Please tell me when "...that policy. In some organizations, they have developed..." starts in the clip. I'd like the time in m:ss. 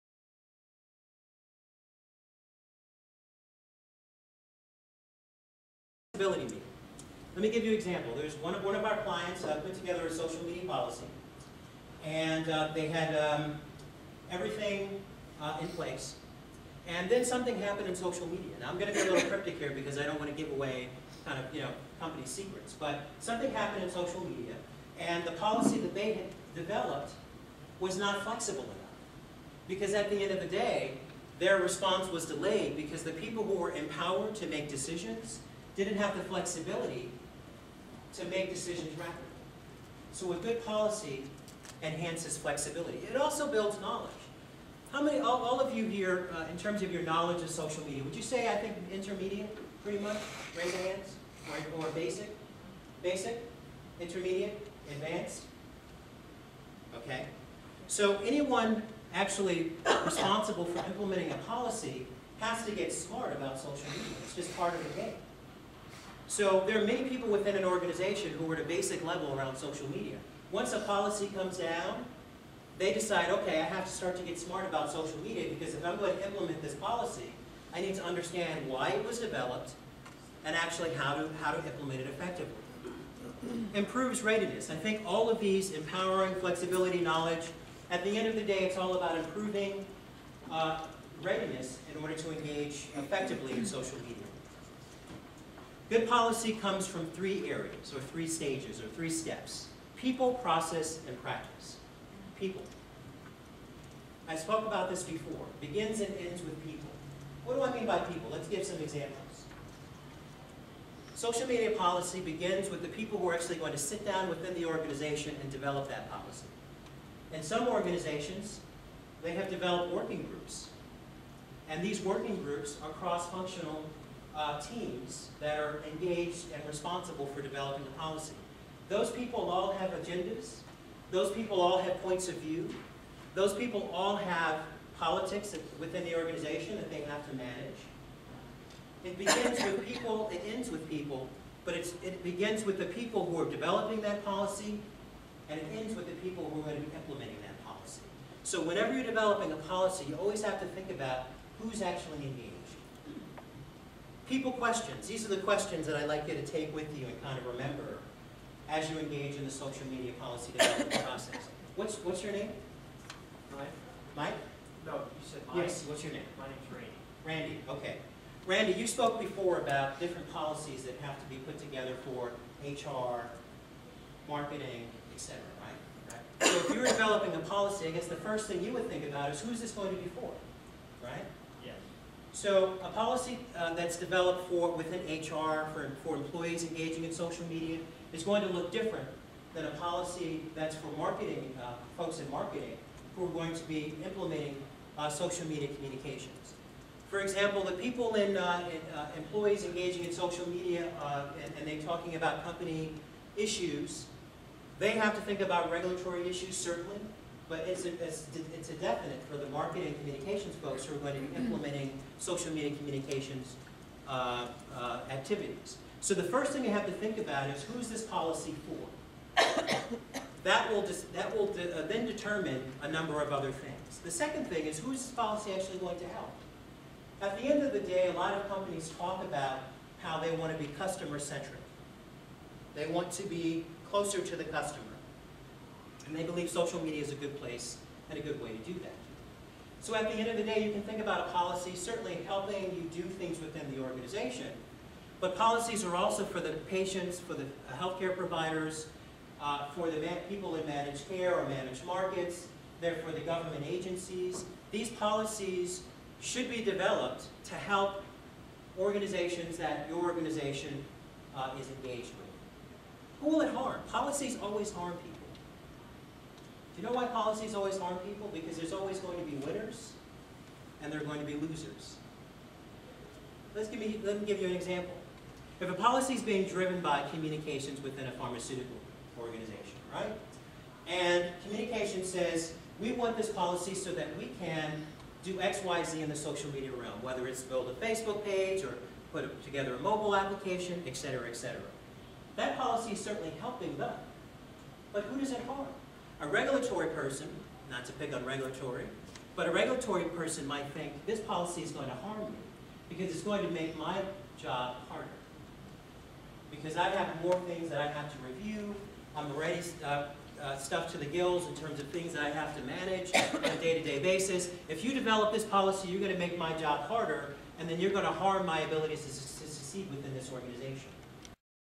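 1:55.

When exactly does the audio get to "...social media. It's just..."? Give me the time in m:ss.
1:03.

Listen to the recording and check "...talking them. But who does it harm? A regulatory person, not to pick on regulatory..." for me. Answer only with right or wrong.
wrong.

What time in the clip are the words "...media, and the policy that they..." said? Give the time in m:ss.
0:24.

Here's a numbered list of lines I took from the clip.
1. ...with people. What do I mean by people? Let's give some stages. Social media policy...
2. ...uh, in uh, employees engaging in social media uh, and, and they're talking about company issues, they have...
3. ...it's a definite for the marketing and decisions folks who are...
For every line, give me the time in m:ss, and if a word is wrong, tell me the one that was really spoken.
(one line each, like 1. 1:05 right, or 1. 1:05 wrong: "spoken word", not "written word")
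1. 1:46 wrong: "examples", not "stages"
2. 3:18 right
3. 3:28 wrong: "communications", not "decisions".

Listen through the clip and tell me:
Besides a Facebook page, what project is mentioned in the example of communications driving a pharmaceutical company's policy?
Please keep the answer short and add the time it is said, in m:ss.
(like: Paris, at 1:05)
A mobile application, at 4:49.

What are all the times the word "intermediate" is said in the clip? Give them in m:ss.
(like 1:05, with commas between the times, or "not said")
0:48, 0:54.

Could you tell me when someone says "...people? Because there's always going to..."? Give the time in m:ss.
4:27.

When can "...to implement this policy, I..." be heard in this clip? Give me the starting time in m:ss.
1:16.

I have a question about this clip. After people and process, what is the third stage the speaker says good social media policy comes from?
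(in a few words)
Practice.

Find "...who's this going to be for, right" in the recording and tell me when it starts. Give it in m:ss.
2:59.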